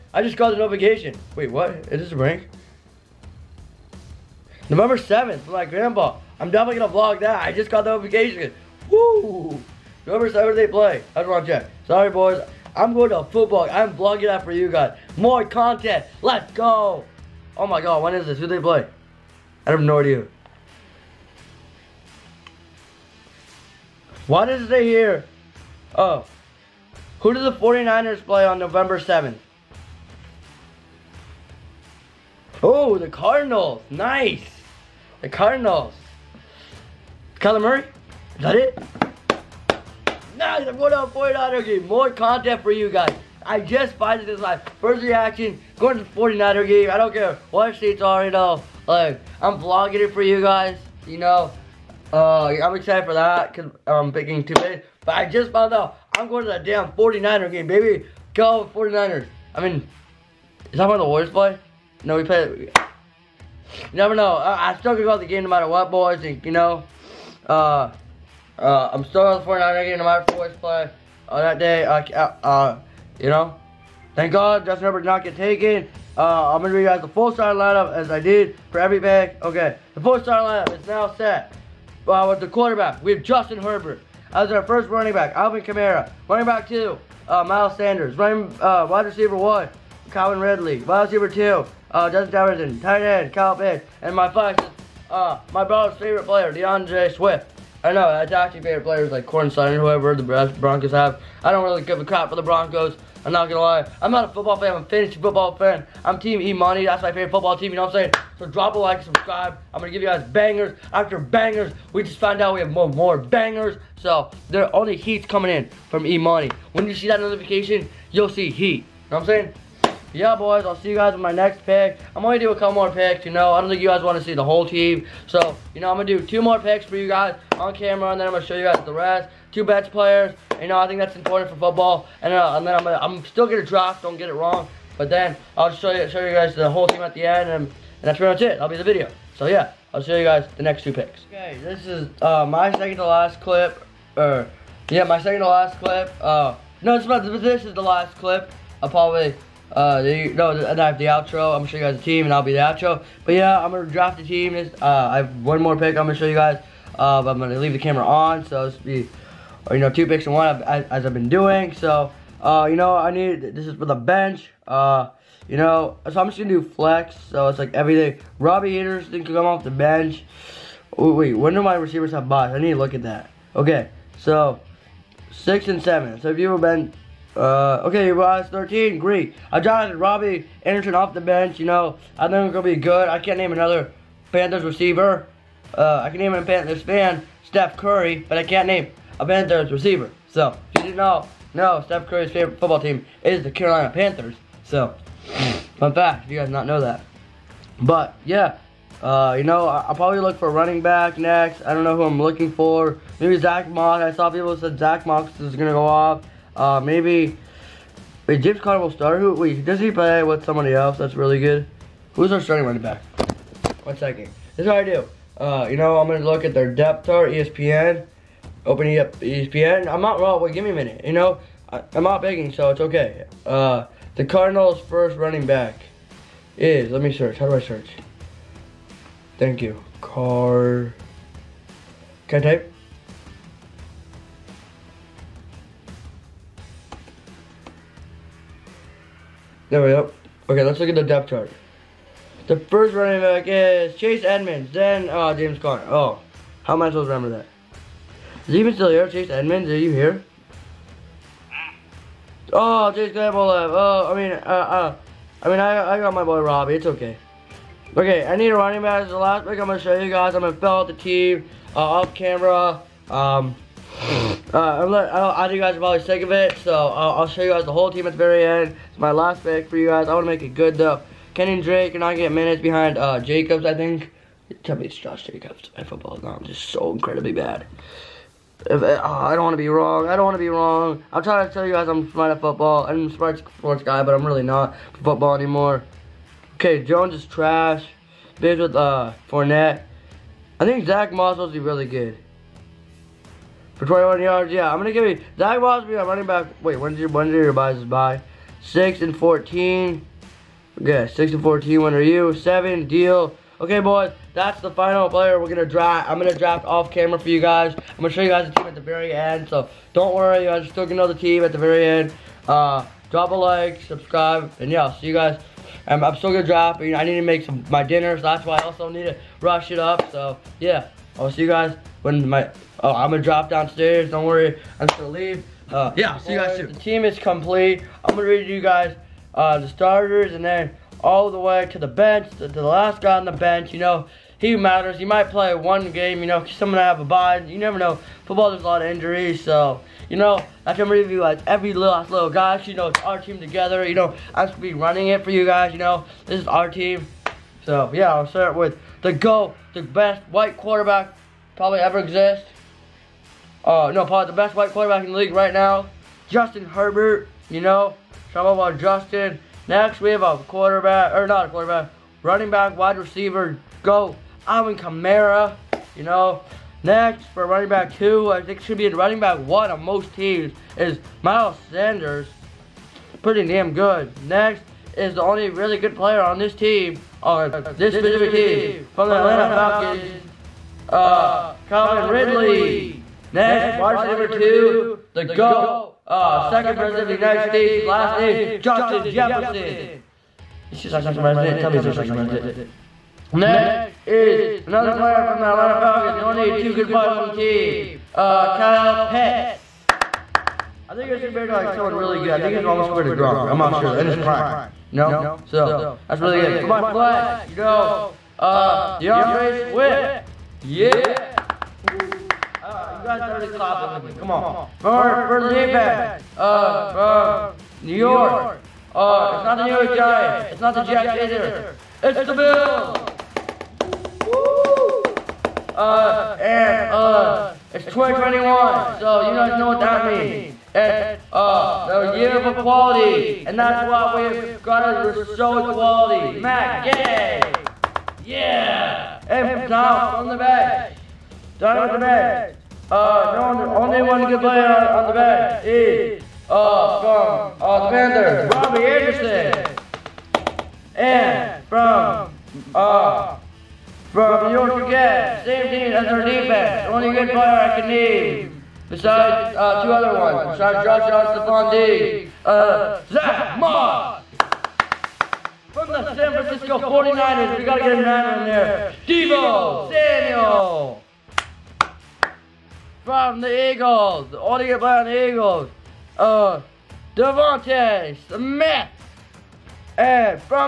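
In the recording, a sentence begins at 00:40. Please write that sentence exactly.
Nice, I'm going to the 49er game.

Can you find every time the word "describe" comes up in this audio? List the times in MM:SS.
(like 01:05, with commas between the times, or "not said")
not said.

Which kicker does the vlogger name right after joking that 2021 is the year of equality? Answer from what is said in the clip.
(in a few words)
Matt Gay.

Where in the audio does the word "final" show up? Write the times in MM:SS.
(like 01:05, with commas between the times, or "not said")
05:04.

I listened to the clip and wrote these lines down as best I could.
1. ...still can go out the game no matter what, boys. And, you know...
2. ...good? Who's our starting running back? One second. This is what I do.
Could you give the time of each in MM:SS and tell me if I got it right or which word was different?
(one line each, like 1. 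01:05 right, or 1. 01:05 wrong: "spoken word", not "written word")
1. 01:04 right
2. 03:31 right.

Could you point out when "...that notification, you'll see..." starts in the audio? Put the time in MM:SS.
01:57.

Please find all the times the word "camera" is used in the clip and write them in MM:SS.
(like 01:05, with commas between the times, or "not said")
02:07, 02:37, 04:22, 05:06.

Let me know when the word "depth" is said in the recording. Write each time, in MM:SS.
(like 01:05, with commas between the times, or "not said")
03:36, 04:01.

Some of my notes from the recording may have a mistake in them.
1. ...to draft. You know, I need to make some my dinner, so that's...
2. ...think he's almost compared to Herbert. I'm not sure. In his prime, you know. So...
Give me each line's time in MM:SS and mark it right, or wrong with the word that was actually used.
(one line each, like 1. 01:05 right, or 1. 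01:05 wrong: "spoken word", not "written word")
1. 05:16 right
2. 06:42 wrong: "Gronk", not "Herbert".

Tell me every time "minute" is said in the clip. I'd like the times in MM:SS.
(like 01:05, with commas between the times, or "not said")
03:40, 04:32.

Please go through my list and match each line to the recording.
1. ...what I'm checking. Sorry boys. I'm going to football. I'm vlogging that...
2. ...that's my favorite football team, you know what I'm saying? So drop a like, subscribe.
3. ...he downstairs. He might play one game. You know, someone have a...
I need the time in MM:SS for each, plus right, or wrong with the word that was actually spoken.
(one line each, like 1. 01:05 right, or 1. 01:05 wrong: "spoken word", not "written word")
1. 00:11 right
2. 01:46 right
3. 05:34 wrong: "matters", not "downstairs".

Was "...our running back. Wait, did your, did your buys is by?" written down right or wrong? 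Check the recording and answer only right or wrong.
right.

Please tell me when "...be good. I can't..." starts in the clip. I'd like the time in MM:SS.
03:02.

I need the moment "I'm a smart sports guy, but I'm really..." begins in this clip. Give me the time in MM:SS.
04:42.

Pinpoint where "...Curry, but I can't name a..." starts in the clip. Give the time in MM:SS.
03:07.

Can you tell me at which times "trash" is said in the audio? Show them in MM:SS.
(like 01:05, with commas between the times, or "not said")
04:47.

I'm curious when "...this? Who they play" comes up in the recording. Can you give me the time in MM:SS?
00:18.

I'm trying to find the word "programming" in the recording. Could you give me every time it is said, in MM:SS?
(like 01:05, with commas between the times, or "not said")
not said.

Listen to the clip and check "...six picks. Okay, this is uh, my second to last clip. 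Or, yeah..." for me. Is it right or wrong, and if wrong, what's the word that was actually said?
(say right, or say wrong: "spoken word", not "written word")
wrong: "two", not "six".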